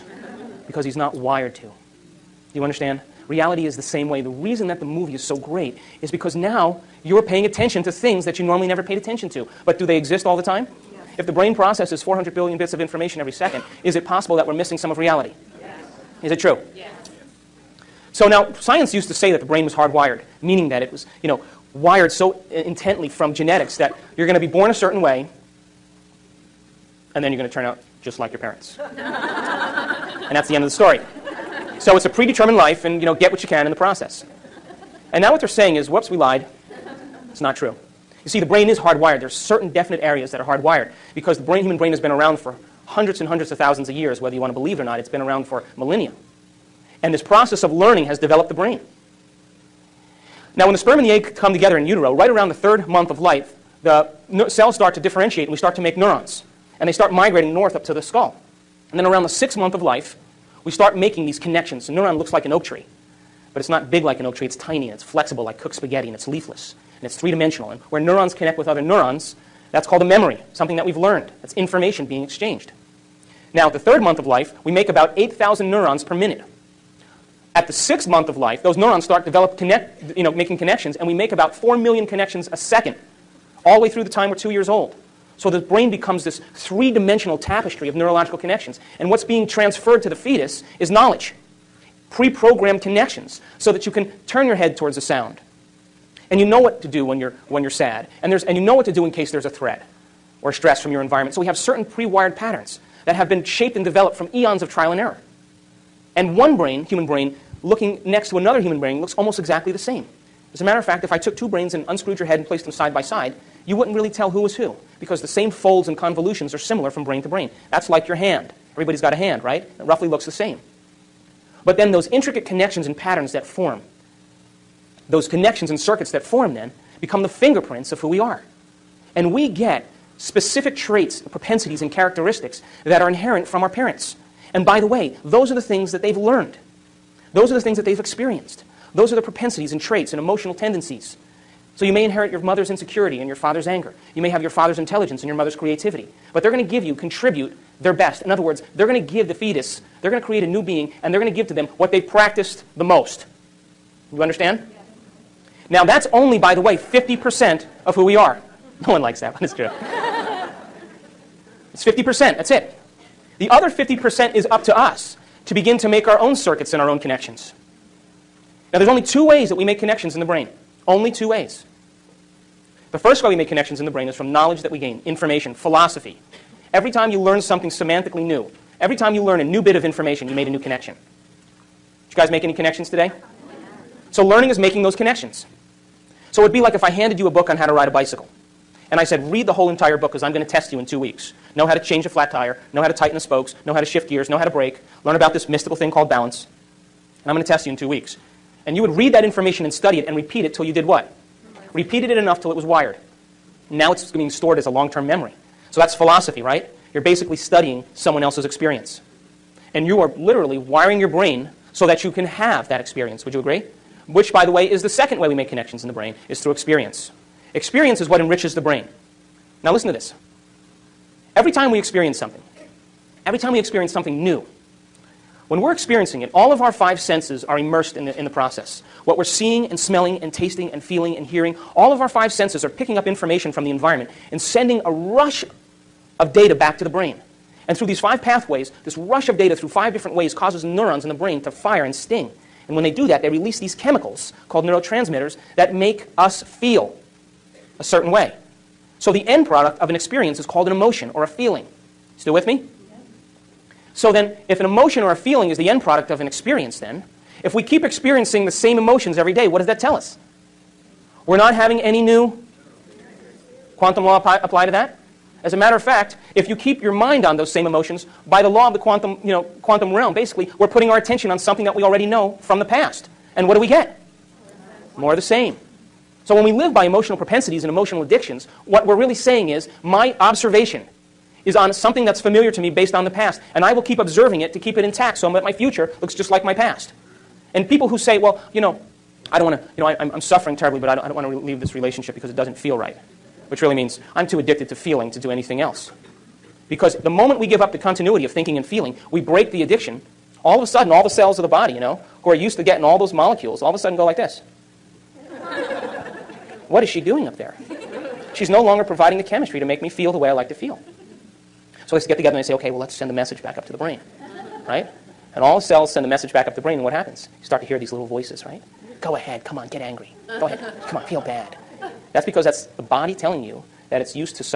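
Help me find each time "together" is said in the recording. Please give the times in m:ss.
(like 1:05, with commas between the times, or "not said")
0:51, 5:12.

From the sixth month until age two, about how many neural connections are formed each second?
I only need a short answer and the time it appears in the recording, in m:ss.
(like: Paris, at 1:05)
4 million, at 1:21.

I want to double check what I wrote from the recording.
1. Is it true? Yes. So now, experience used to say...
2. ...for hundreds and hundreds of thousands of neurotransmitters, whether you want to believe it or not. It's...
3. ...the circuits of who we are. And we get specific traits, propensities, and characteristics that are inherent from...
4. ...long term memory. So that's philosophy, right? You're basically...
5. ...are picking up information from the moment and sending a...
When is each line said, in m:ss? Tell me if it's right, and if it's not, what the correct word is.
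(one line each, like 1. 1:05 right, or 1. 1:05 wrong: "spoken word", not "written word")
1. 0:16 wrong: "science", not "experience"
2. 0:42 wrong: "years", not "neurotransmitters"
3. 2:07 wrong: "fingerprints", not "circuits"
4. 3:24 right
5. 3:52 wrong: "environment", not "moment".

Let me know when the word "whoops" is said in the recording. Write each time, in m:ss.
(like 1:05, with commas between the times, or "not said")
0:35.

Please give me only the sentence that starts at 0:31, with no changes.
So it's a predetermined life, and you know, get what you can in the process.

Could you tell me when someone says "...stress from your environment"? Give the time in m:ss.
1:40.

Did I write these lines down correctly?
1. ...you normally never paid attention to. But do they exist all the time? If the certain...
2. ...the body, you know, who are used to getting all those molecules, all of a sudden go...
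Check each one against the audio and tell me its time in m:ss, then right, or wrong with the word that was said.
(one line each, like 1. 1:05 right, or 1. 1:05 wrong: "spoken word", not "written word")
1. 0:08 wrong: "brain", not "certain"
2. 5:01 right.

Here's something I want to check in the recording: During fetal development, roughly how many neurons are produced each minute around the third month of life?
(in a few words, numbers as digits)
8,000.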